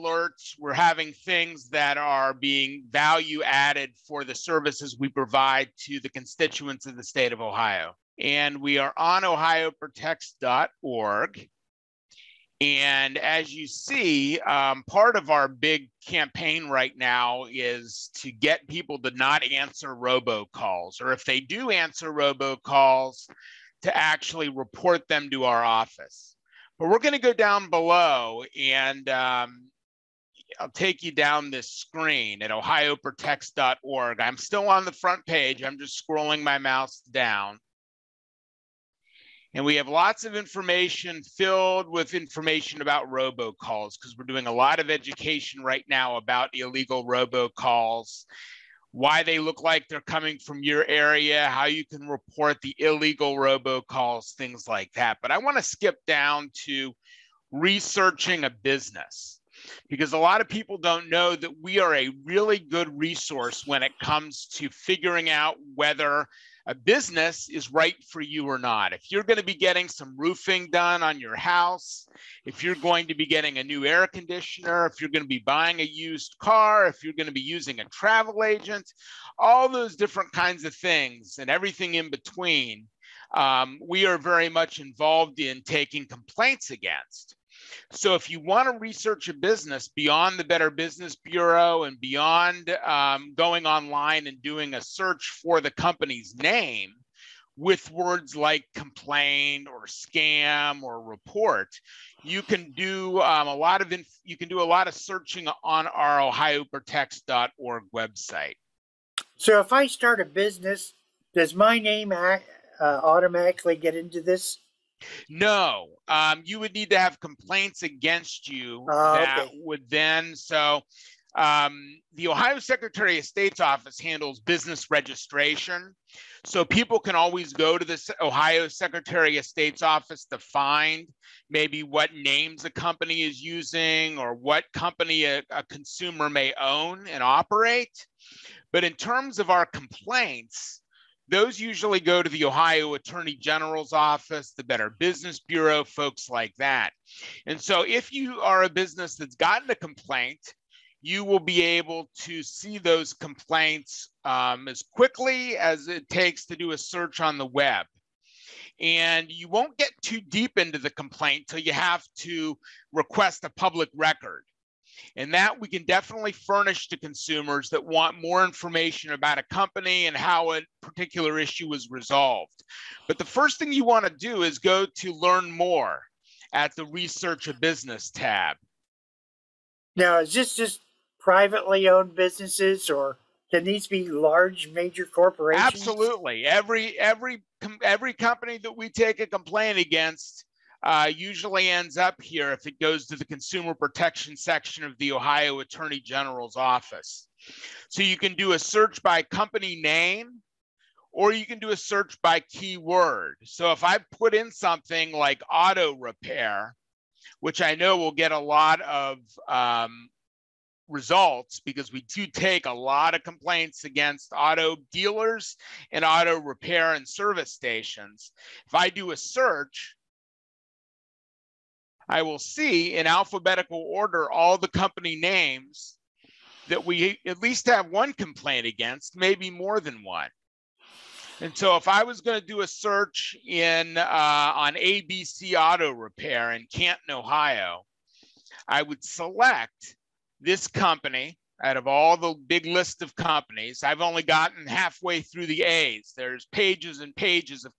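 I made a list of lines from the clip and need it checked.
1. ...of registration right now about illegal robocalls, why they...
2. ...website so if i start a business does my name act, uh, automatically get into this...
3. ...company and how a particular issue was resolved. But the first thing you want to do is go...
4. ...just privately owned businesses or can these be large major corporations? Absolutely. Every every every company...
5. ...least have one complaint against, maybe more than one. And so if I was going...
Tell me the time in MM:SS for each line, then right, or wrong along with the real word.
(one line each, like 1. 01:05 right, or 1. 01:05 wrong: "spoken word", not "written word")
1. 00:44 wrong: "education", not "registration"
2. 01:47 right
3. 02:49 right
4. 03:00 right
5. 03:47 right.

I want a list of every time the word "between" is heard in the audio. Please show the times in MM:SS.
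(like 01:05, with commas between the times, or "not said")
01:22.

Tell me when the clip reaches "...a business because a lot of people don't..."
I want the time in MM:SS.
00:58.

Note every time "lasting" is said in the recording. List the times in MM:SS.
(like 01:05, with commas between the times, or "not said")
not said.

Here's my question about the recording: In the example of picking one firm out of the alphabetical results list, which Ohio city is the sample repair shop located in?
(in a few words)
Canton.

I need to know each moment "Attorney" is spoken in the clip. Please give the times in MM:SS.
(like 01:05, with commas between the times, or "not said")
02:22, 03:15.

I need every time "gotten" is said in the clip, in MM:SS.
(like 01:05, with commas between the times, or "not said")
02:29, 04:04.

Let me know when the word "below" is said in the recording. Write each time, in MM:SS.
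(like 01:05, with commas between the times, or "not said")
00:27.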